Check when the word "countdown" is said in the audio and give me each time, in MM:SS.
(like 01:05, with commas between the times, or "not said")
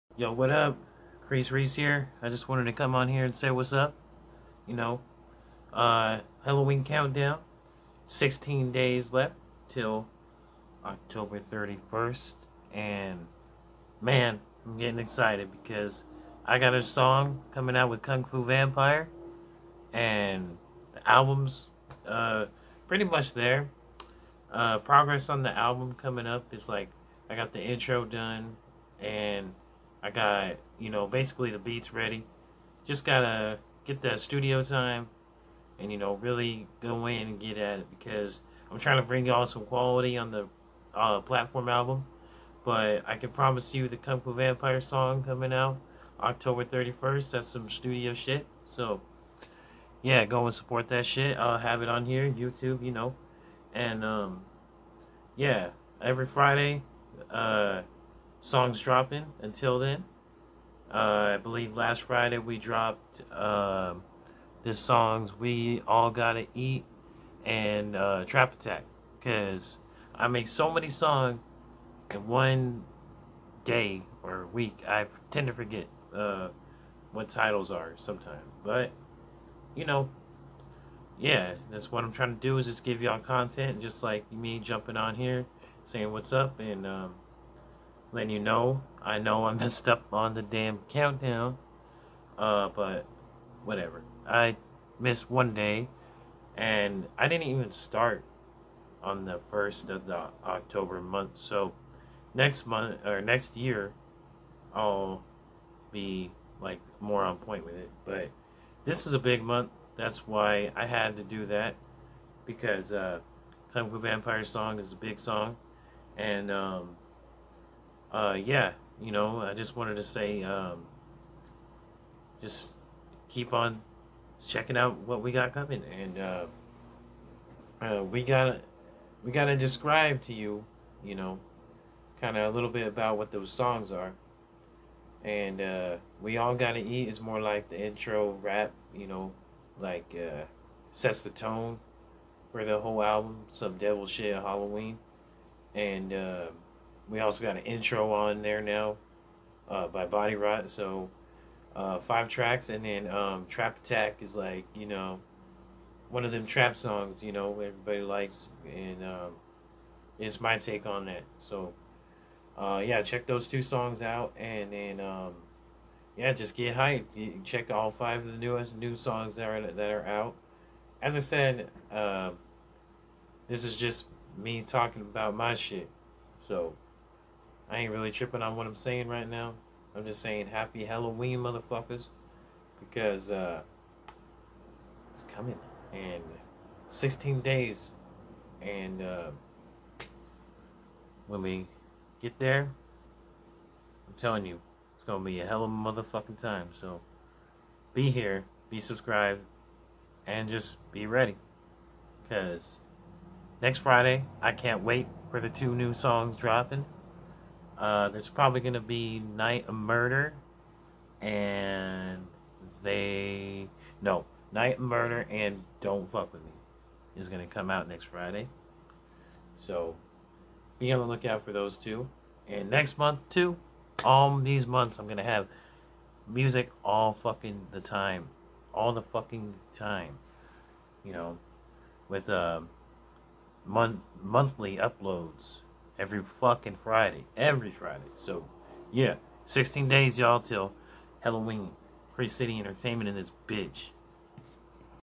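00:06, 01:30.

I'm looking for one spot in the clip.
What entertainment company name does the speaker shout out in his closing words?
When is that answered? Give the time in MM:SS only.
04:02.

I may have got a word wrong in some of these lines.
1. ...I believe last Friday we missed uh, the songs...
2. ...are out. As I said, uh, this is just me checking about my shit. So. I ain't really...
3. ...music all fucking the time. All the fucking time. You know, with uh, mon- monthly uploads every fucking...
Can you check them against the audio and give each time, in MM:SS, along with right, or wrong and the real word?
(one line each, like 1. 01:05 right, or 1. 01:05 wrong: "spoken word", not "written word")
1. 01:01 wrong: "dropped", not "missed"
2. 02:49 wrong: "talking", not "checking"
3. 03:46 right.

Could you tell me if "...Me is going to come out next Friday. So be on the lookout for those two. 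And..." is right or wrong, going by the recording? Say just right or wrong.
right.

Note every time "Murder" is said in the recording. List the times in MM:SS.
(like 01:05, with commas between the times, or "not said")
03:29, 03:34.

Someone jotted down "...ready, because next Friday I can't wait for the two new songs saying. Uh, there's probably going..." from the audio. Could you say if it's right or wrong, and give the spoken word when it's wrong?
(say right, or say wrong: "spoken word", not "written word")
wrong: "dropping", not "saying".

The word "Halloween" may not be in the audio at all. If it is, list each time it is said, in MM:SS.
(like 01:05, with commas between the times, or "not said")
00:06, 02:24, 03:00, 04:01.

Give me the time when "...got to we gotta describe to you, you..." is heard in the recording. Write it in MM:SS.
02:08.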